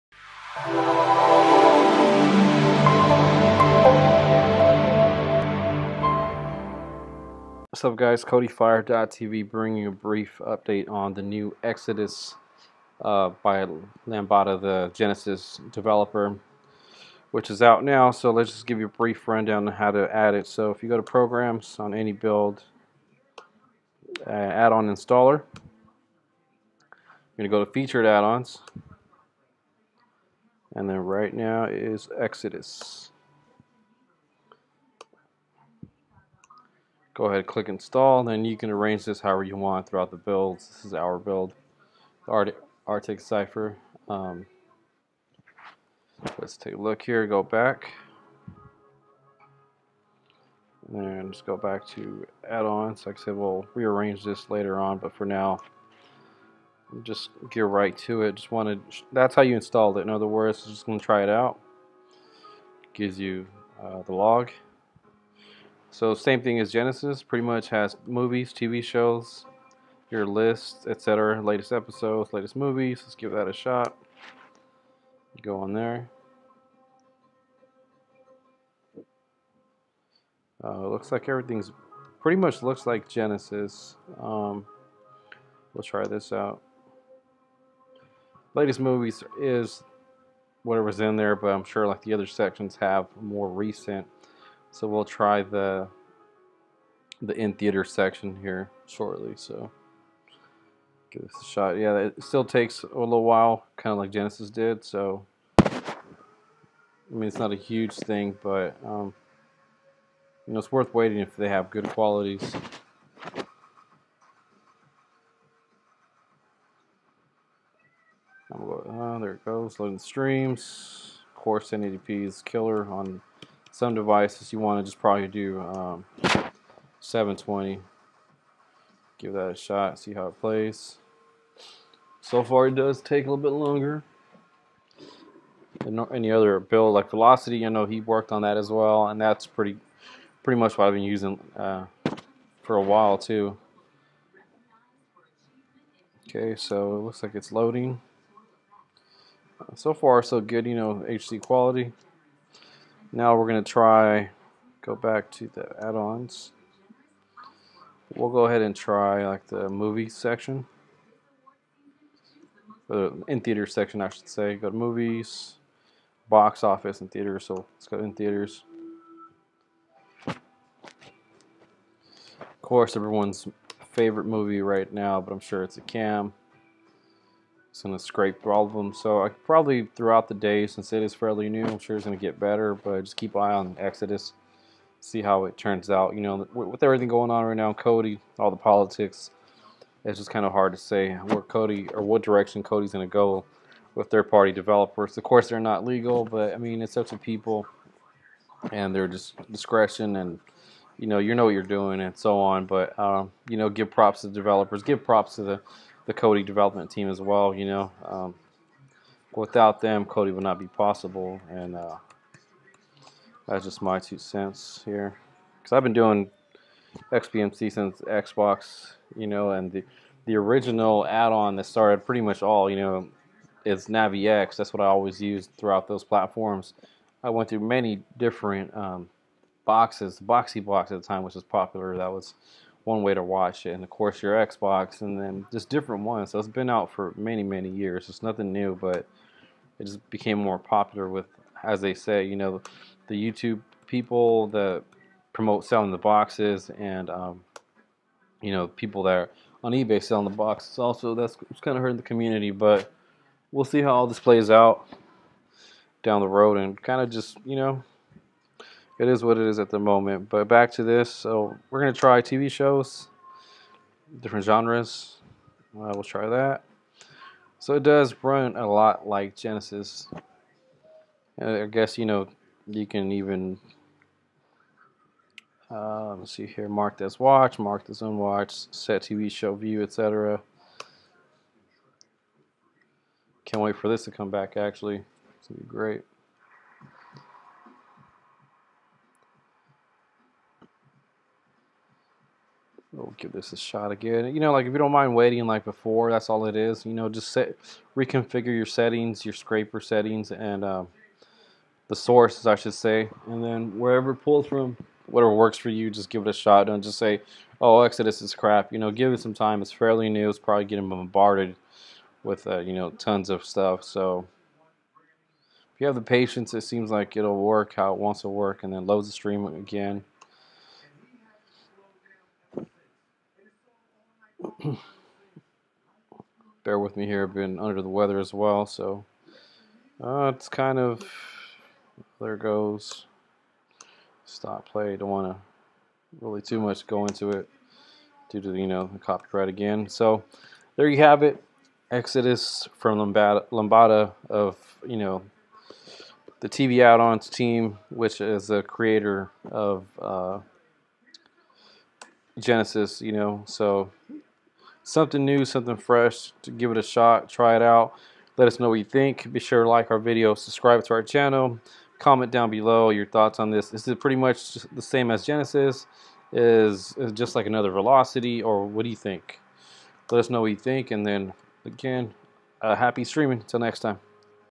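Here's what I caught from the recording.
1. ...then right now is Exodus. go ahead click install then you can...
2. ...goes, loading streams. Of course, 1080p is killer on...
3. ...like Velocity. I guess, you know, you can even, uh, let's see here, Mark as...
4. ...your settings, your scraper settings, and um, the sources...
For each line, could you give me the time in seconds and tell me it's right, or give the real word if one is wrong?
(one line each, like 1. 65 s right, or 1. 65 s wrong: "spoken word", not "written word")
1. 30 s right
2. 119 s right
3. 269 s wrong: "Genesis", not "Velocity"
4. 298 s right.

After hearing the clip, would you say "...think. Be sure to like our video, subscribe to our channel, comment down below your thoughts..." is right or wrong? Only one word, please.
right.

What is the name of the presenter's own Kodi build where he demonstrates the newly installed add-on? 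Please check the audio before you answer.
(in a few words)
Arctic Cypher.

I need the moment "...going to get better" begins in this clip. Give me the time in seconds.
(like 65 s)
182 s.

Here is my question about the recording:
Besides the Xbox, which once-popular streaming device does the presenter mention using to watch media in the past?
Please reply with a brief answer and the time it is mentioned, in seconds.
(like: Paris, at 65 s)
Boxee Box, at 230 s.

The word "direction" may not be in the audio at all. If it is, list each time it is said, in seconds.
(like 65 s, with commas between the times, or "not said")
192 s.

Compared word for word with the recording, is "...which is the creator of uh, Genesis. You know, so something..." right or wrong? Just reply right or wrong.
right.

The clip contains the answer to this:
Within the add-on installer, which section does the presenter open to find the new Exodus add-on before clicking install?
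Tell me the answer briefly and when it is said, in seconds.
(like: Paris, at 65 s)
Featured Add-ons, at 27 s.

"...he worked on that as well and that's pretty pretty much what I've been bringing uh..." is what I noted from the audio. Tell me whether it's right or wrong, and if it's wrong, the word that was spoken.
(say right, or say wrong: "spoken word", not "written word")
wrong: "using", not "bringing".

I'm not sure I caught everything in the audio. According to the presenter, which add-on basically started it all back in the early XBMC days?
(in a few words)
Navi-X.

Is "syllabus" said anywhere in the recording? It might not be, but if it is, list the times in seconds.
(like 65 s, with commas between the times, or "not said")
not said.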